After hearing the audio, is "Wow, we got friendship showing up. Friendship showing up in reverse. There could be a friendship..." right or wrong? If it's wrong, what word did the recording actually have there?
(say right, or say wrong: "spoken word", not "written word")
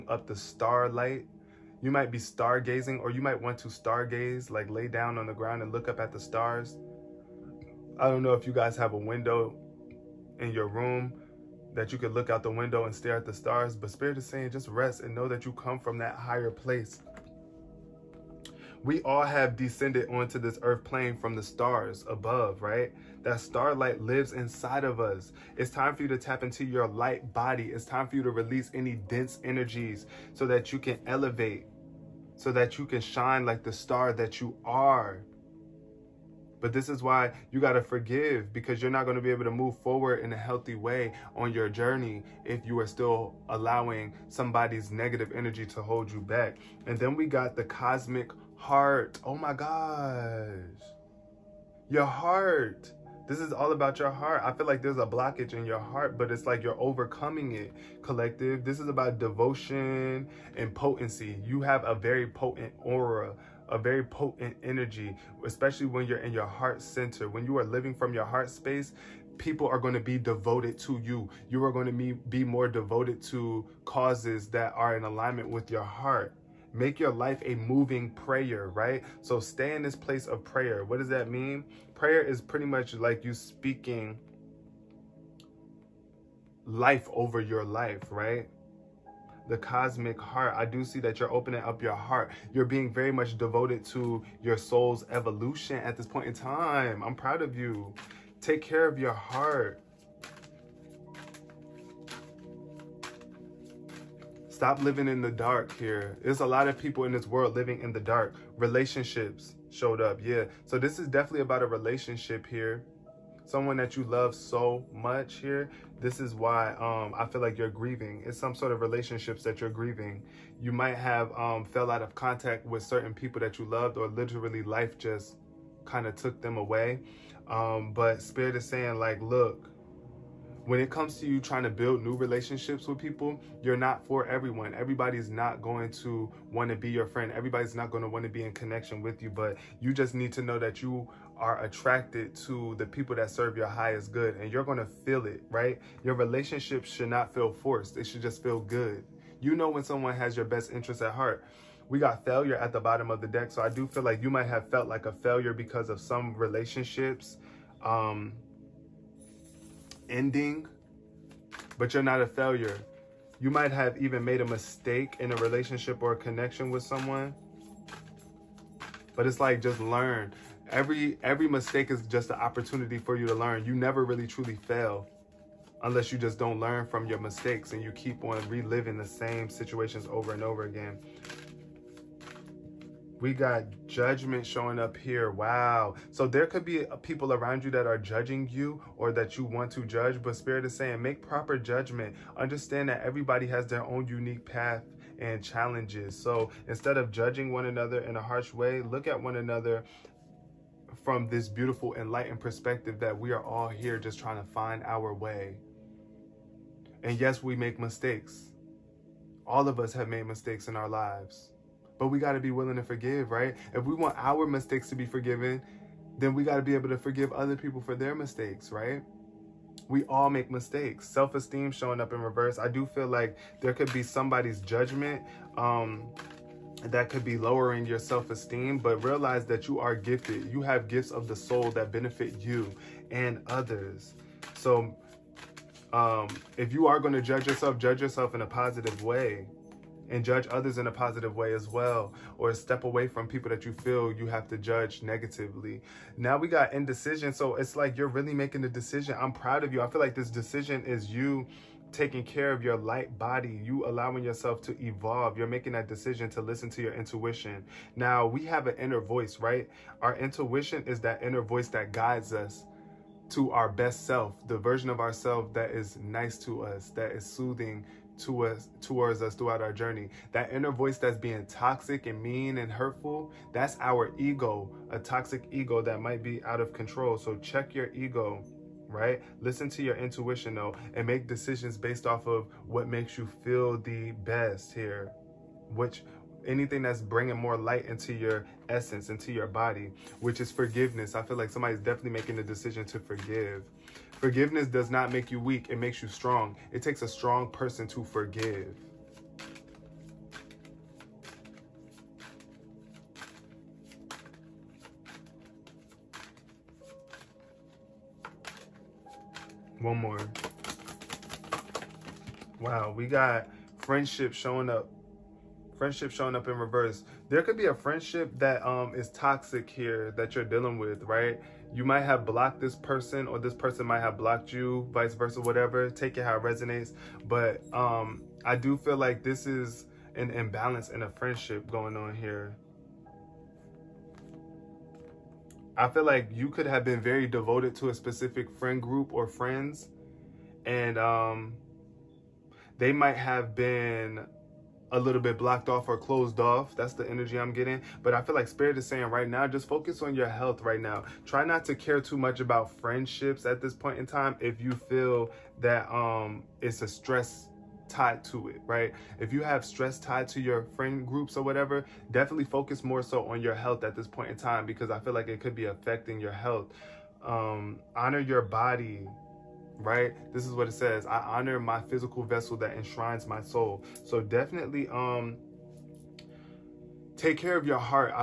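right.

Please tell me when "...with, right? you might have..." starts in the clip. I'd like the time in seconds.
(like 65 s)
320 s.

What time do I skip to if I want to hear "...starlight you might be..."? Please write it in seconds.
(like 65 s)
0 s.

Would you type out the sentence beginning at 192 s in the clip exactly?
Understand that everybody has their own unique path and challenges.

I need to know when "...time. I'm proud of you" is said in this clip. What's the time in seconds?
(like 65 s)
96 s.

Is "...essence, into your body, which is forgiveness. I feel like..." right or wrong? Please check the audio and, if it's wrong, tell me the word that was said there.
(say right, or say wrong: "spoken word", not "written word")
right.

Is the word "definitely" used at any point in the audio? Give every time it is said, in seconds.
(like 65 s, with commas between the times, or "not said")
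111 s, 291 s, 362 s, 374 s.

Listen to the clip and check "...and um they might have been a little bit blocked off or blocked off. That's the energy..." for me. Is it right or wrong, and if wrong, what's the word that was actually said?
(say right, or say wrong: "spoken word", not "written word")
wrong: "closed", not "blocked".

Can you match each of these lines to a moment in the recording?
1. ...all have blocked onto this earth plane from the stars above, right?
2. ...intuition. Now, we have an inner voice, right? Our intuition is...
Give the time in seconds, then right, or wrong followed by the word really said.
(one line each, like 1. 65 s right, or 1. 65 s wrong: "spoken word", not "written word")
1. 19 s wrong: "descended", not "blocked"
2. 256 s right.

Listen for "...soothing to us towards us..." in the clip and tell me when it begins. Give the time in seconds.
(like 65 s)
267 s.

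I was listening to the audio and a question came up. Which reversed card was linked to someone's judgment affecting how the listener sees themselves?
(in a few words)
Self esteem.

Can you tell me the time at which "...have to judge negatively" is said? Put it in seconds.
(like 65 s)
244 s.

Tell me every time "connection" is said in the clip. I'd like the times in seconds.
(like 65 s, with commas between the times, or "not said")
138 s, 166 s.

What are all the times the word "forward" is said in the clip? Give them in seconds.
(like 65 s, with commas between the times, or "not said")
39 s.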